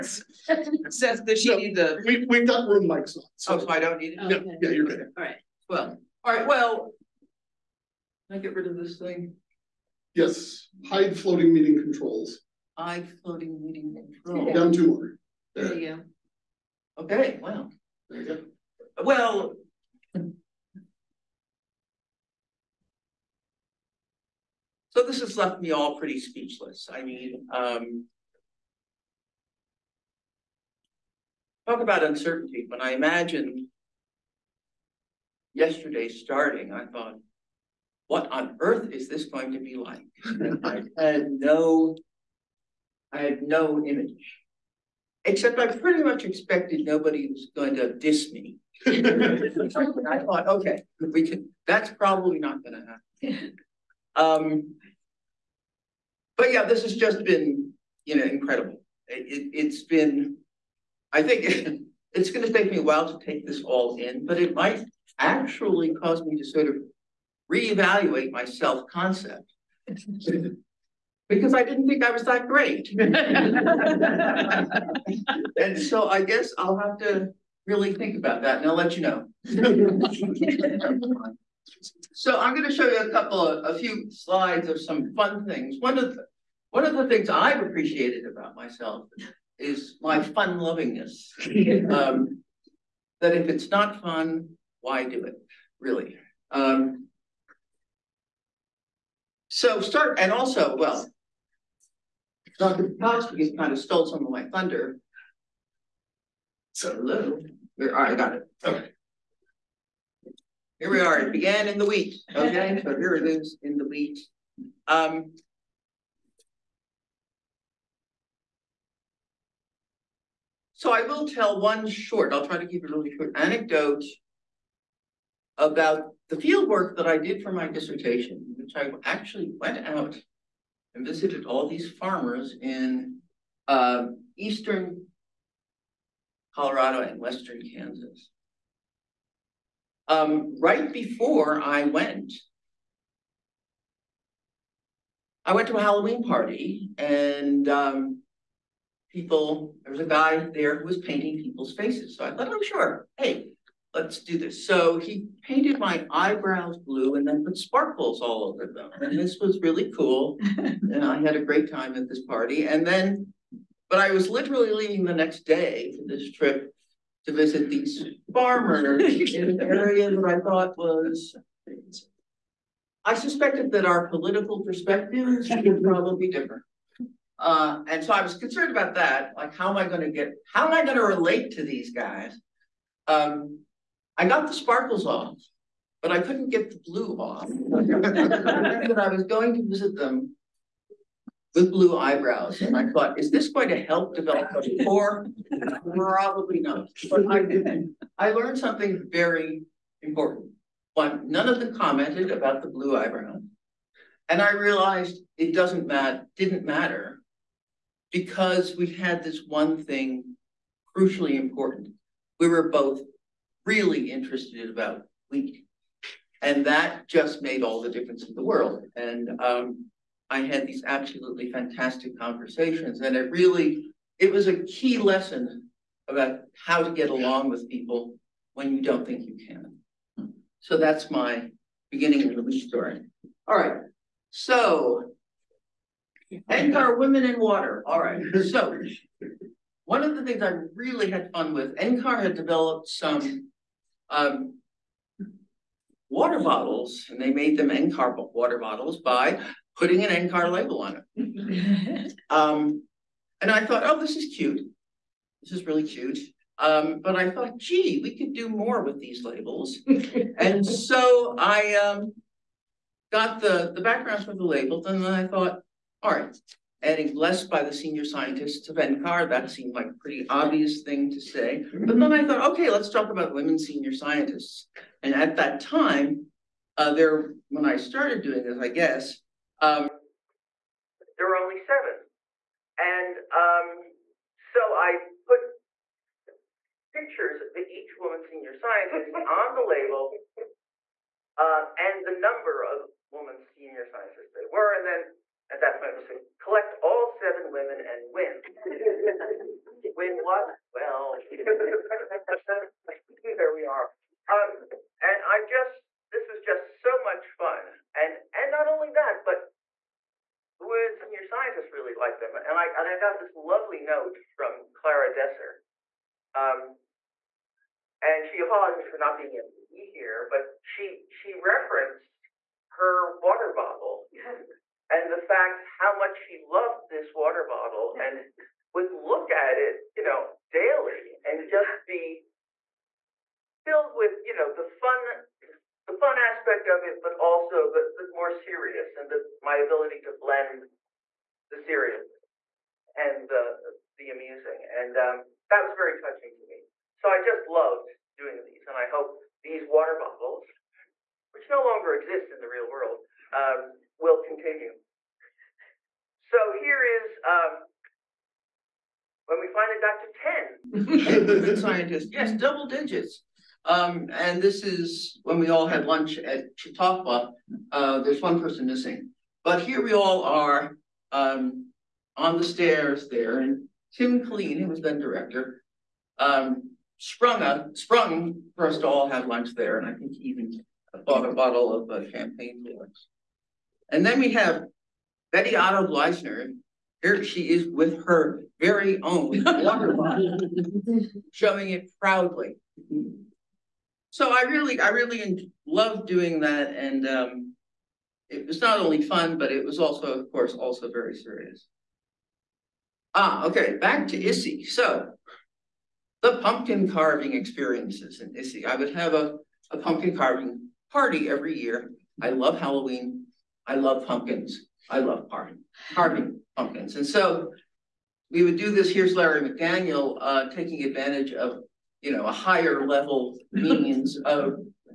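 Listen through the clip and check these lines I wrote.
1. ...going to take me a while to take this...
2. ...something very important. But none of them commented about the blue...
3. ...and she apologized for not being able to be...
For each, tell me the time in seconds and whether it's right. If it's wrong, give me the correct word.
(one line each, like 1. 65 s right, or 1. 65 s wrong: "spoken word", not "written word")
1. 62 s right
2. 198 s right
3. 318 s right.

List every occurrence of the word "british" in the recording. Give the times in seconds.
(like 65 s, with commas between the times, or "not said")
not said.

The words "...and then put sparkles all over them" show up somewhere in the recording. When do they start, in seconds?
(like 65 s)
157 s.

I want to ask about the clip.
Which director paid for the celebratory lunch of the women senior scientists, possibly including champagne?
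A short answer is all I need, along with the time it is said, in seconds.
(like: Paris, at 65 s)
Tim Killeen, at 373 s.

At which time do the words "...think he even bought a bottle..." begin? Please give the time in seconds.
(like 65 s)
379 s.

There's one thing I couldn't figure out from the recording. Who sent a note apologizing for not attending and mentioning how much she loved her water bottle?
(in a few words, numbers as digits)
Clara Deser.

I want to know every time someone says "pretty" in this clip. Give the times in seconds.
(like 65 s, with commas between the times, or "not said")
25 s, 45 s, 269 s.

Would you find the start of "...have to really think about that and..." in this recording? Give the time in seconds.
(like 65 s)
76 s.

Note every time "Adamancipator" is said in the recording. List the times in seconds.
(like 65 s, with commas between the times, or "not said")
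not said.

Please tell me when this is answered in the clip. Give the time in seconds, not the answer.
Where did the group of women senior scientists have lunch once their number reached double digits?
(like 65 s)
366 s.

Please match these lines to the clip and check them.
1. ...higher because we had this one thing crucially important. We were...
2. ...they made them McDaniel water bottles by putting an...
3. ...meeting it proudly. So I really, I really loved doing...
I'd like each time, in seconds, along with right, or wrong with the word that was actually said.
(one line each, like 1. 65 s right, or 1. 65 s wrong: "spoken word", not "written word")
1. 206 s wrong: "matter", not "higher"
2. 247 s wrong: "NCAR", not "McDaniel"
3. 391 s wrong: "showing", not "meeting".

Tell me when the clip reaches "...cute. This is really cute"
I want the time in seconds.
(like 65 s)
254 s.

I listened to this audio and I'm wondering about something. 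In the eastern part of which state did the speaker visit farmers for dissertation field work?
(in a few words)
Colorado.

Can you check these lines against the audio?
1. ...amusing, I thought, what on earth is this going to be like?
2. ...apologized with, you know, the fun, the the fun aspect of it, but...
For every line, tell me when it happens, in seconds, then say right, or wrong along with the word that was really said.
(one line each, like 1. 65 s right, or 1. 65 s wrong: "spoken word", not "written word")
1. 36 s wrong: "starting", not "amusing"
2. 333 s wrong: "filled", not "apologized".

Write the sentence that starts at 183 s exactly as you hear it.
Um, I got the sparkles off, but I couldn't get the blue off.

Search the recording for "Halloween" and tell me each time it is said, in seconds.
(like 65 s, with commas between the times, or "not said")
145 s, 412 s.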